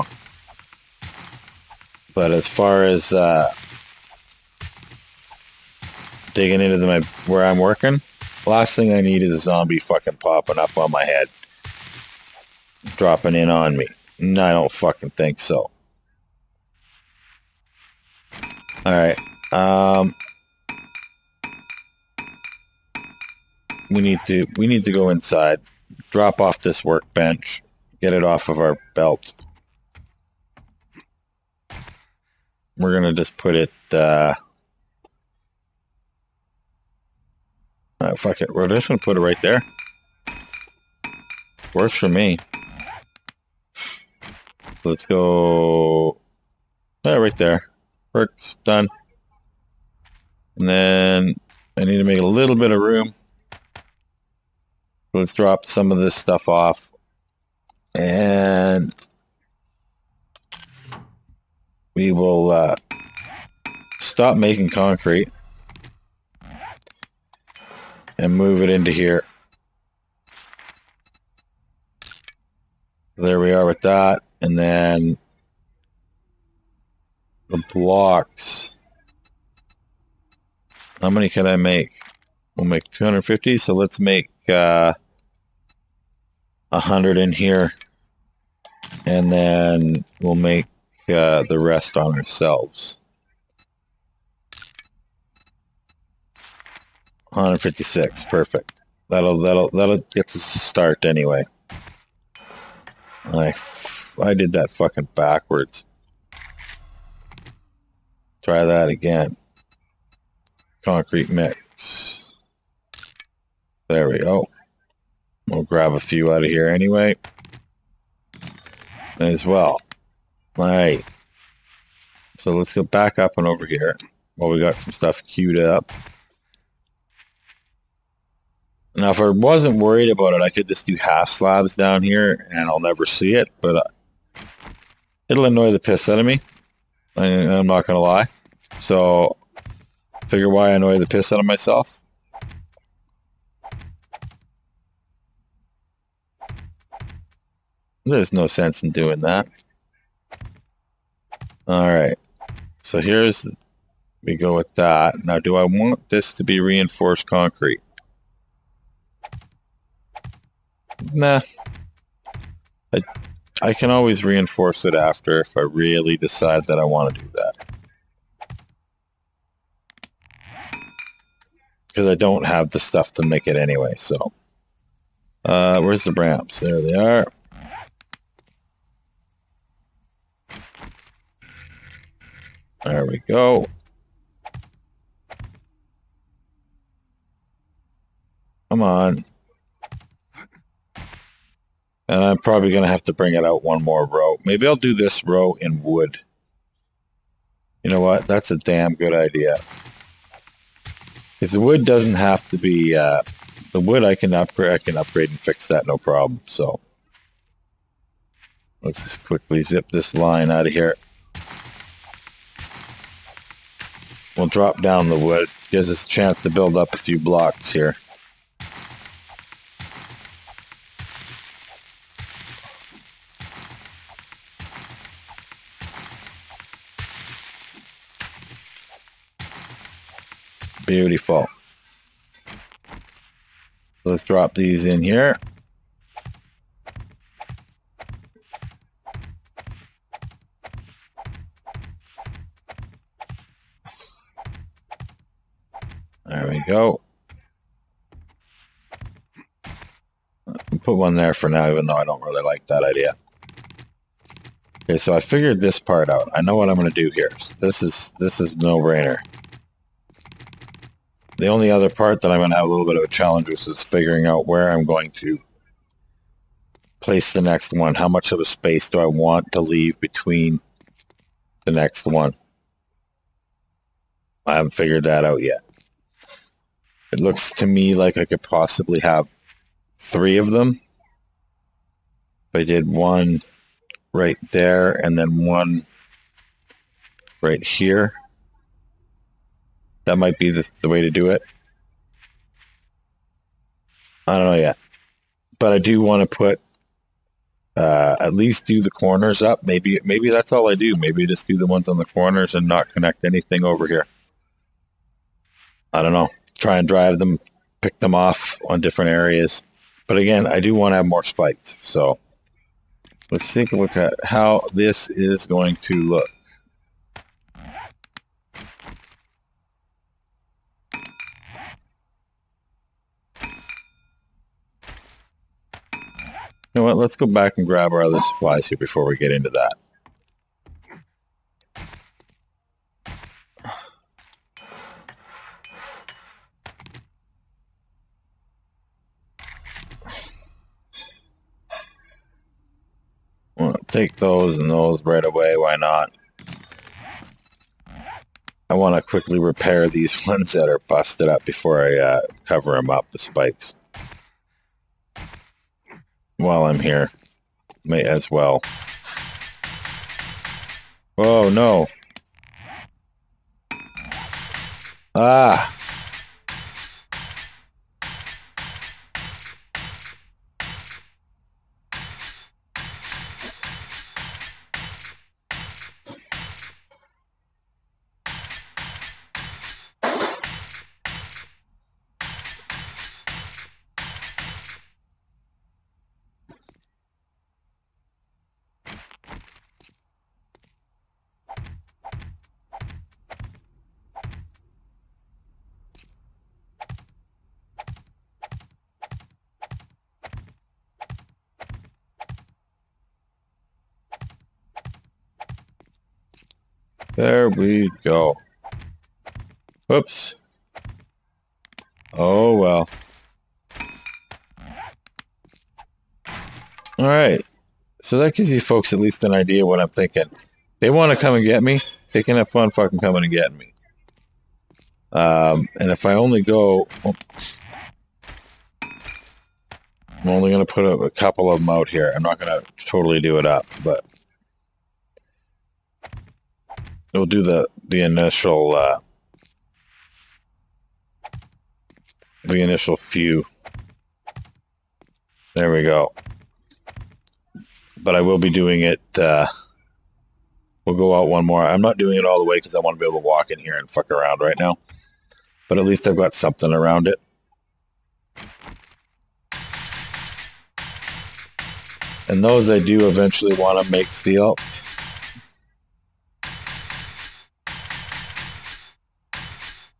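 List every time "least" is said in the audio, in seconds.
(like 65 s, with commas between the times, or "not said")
298 s, 418 s, 455 s.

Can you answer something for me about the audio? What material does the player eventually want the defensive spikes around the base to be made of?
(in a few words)
steel.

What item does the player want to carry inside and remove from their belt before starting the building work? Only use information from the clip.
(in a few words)
workbench.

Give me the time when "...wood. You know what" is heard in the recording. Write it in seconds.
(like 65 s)
195 s.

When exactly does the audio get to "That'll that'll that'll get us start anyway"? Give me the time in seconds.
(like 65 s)
99 s.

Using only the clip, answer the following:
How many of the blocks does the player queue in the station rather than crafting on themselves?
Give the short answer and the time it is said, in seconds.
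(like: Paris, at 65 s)
100, at 86 s.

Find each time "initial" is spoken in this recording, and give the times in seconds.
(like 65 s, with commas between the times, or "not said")
438 s, 442 s.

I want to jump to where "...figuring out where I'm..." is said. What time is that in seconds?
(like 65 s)
263 s.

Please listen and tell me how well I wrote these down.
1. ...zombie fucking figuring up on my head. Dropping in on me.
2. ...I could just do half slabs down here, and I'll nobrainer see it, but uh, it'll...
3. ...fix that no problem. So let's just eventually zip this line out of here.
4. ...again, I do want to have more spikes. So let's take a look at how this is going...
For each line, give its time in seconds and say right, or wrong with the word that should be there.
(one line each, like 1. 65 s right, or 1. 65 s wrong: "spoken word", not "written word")
1. 9 s wrong: "popping", not "figuring"
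2. 130 s wrong: "never", not "nobrainer"
3. 205 s wrong: "quickly", not "eventually"
4. 310 s right.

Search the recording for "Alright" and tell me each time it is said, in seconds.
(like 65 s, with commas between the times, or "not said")
18 s, 120 s, 151 s, 416 s.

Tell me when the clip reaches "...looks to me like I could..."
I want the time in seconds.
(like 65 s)
277 s.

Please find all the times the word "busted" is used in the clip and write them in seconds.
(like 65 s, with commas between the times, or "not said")
350 s.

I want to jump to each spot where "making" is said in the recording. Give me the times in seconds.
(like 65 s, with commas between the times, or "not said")
64 s.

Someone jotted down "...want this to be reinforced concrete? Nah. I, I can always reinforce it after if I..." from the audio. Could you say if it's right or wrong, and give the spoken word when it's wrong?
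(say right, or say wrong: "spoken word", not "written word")
right.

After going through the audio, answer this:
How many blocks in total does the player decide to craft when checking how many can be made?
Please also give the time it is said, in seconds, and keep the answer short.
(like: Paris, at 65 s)
250, at 82 s.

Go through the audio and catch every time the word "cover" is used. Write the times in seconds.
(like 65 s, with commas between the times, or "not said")
352 s.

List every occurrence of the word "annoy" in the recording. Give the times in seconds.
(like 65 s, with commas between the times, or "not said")
135 s, 140 s.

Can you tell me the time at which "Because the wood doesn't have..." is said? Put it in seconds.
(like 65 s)
201 s.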